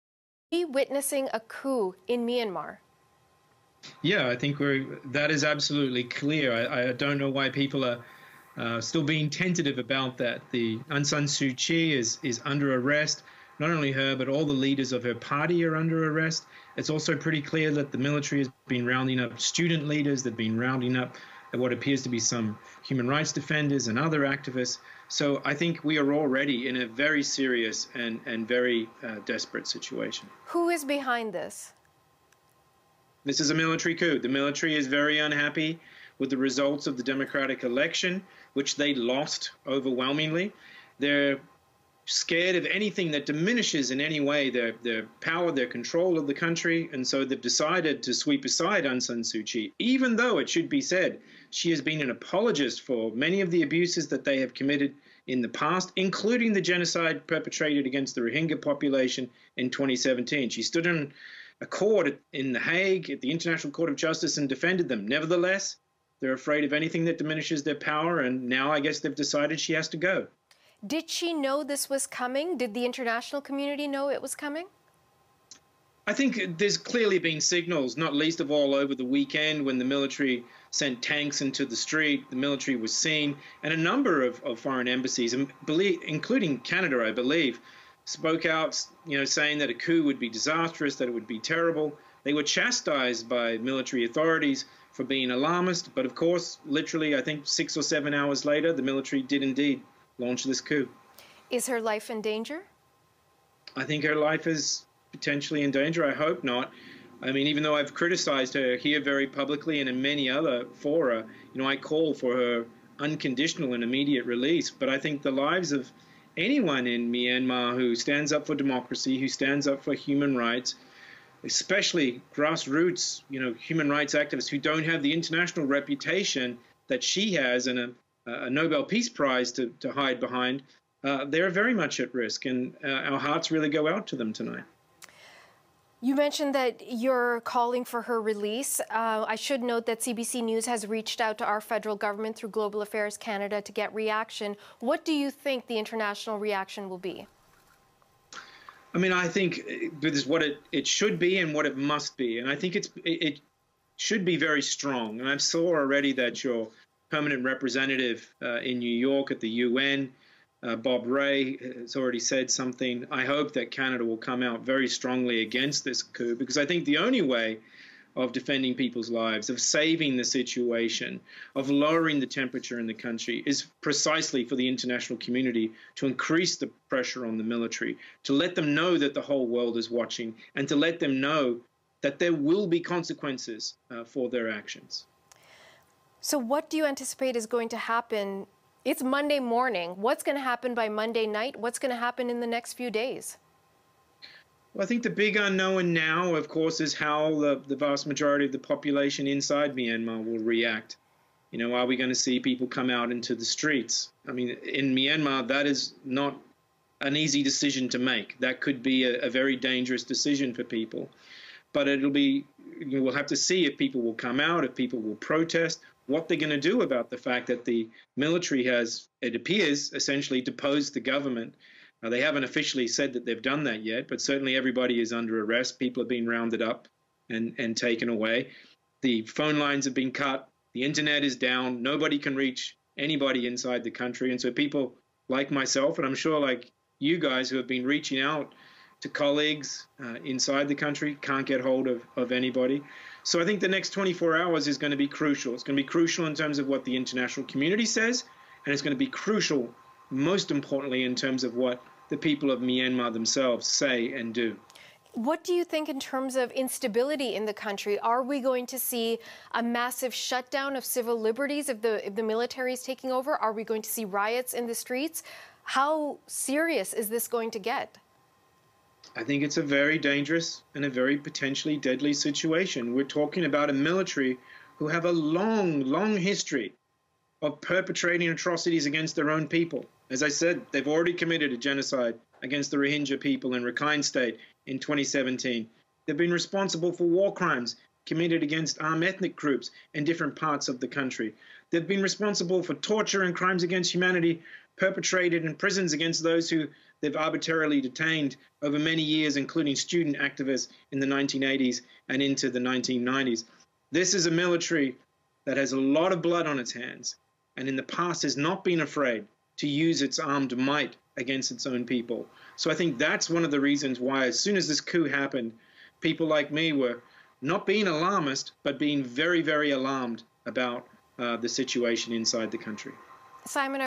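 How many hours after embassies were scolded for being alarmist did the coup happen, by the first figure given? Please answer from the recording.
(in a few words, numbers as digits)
6.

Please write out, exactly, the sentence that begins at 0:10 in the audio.
The Aung San Suu Kyi is, is under arrest.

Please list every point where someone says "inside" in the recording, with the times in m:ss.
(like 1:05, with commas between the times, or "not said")
3:19, 3:53, 4:00, 5:22.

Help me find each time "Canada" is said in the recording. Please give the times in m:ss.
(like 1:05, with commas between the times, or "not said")
1:26, 2:23, 2:43.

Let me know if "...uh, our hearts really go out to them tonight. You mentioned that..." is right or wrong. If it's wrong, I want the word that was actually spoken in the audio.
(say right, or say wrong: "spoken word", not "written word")
right.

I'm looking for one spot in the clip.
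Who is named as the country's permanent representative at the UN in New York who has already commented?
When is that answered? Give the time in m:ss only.
2:40.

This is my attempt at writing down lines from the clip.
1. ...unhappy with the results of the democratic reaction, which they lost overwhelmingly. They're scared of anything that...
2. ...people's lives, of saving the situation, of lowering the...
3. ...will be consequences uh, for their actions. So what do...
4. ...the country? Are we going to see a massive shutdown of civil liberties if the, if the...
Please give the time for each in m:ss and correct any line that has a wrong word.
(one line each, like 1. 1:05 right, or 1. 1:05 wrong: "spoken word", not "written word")
1. 0:35 wrong: "election", not "reaction"
2. 2:48 right
3. 3:02 right
4. 4:17 right.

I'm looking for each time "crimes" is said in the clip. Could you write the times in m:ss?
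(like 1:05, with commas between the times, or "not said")
4:47, 4:53.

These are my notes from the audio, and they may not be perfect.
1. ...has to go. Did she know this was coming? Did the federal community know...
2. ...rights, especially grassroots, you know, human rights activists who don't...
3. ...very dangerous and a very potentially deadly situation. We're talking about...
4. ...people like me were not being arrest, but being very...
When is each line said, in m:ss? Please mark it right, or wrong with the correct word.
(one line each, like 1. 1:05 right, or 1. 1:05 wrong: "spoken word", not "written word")
1. 1:09 wrong: "international", not "federal"
2. 2:00 right
3. 4:29 right
4. 5:15 wrong: "alarmist", not "arrest".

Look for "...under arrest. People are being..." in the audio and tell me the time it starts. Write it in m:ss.
3:45.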